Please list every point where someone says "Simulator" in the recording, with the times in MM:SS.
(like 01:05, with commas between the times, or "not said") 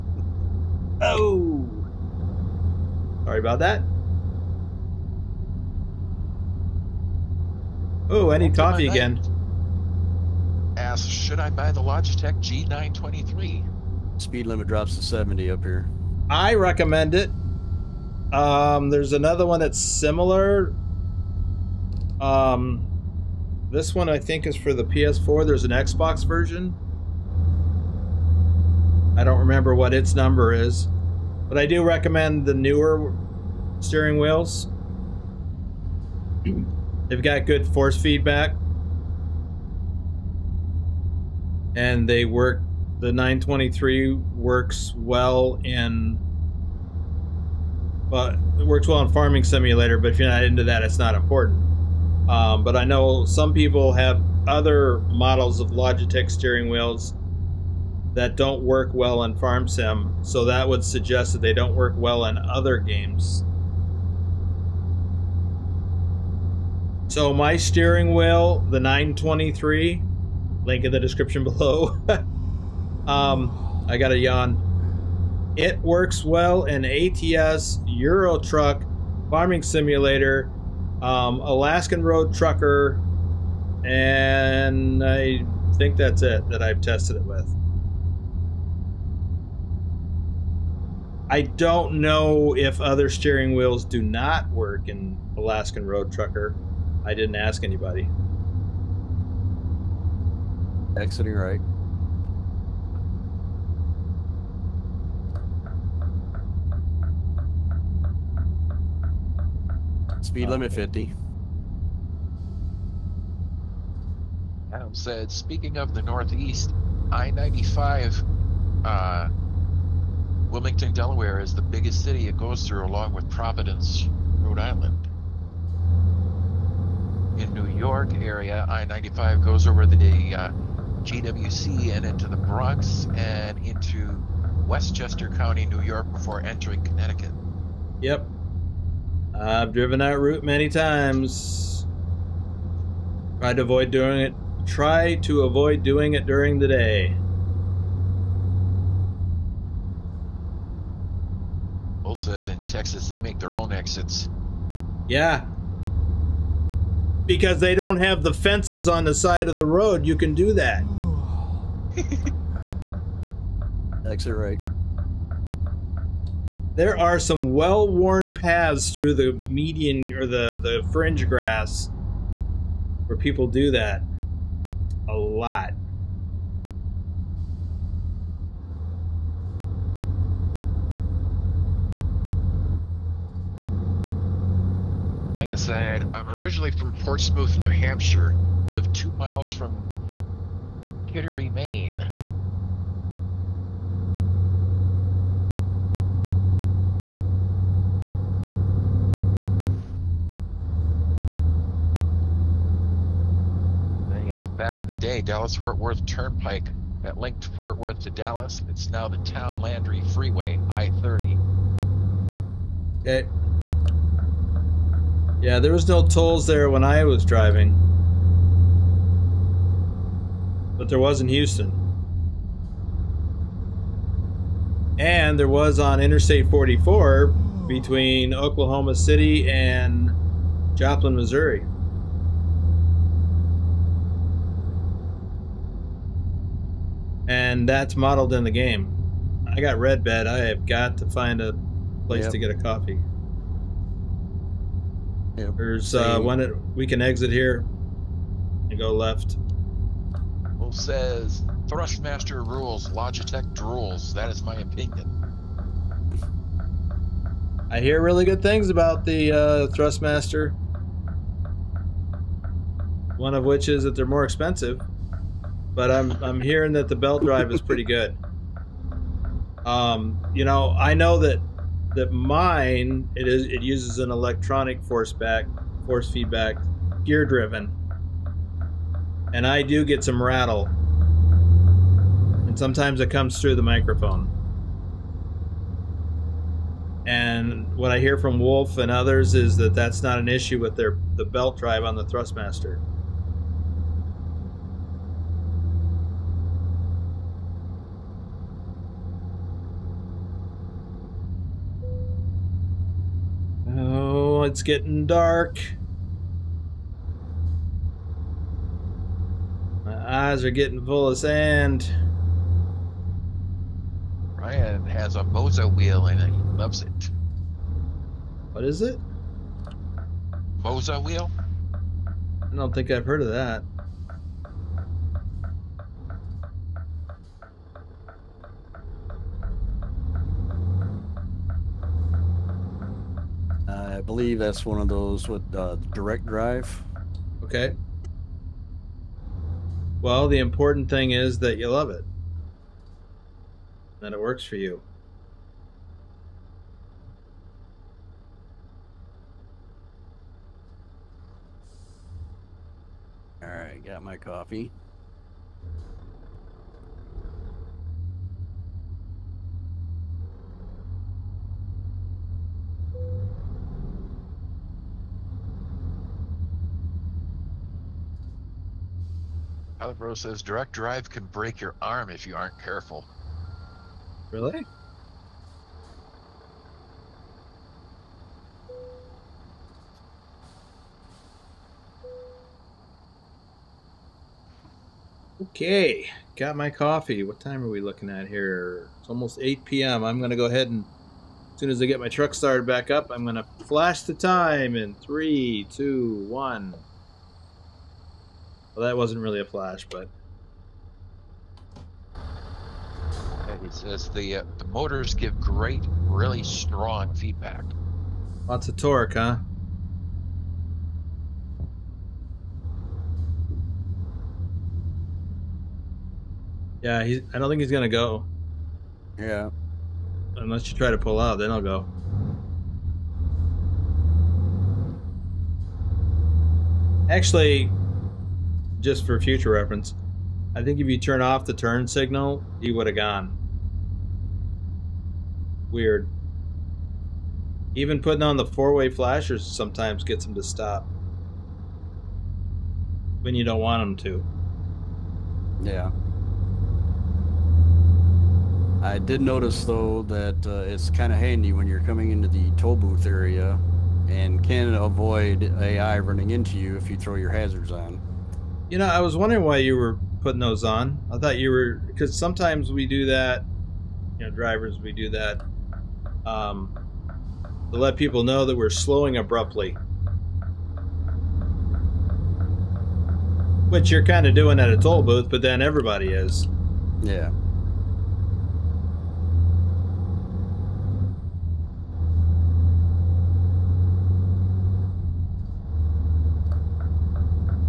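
00:49, 01:19.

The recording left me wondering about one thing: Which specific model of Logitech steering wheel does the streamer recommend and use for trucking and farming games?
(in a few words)
G923.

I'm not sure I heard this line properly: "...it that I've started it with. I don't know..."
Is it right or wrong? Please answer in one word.
wrong.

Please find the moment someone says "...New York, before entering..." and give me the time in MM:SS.
02:15.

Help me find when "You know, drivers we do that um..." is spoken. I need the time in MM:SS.
07:44.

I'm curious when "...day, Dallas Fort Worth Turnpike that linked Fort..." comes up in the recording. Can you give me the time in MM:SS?
03:24.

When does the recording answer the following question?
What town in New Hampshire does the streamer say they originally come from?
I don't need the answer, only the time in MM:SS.
03:07.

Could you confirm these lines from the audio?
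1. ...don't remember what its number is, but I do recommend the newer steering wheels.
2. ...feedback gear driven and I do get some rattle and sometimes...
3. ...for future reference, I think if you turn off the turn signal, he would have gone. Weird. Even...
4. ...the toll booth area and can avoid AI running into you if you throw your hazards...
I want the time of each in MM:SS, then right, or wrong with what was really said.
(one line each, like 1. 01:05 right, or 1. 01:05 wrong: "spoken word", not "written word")
1. 00:29 right
2. 04:36 right
3. 07:09 right
4. 07:32 right.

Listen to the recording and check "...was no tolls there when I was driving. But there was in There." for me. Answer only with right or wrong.
wrong.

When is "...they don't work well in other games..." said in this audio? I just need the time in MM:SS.
01:01.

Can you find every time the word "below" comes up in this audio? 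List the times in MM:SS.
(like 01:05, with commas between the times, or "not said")
01:11.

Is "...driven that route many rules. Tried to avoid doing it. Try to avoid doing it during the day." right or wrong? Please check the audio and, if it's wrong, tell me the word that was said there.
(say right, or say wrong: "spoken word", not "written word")
wrong: "times", not "rules".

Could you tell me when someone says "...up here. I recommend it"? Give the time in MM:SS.
00:15.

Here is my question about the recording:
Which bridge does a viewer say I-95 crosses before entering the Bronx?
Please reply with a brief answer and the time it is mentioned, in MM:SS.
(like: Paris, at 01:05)
GWB, at 02:11.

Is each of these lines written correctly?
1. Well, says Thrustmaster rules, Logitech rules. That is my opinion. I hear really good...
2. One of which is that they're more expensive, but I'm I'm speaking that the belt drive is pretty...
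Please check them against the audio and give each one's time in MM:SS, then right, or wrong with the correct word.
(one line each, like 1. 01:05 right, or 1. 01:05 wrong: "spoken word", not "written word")
1. 04:10 right
2. 04:23 wrong: "hearing", not "speaking".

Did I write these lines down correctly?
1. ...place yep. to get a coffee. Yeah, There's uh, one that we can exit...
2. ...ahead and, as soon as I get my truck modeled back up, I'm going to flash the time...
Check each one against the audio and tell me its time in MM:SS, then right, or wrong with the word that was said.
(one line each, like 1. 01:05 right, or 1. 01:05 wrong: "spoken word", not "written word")
1. 04:02 right
2. 06:30 wrong: "started", not "modeled".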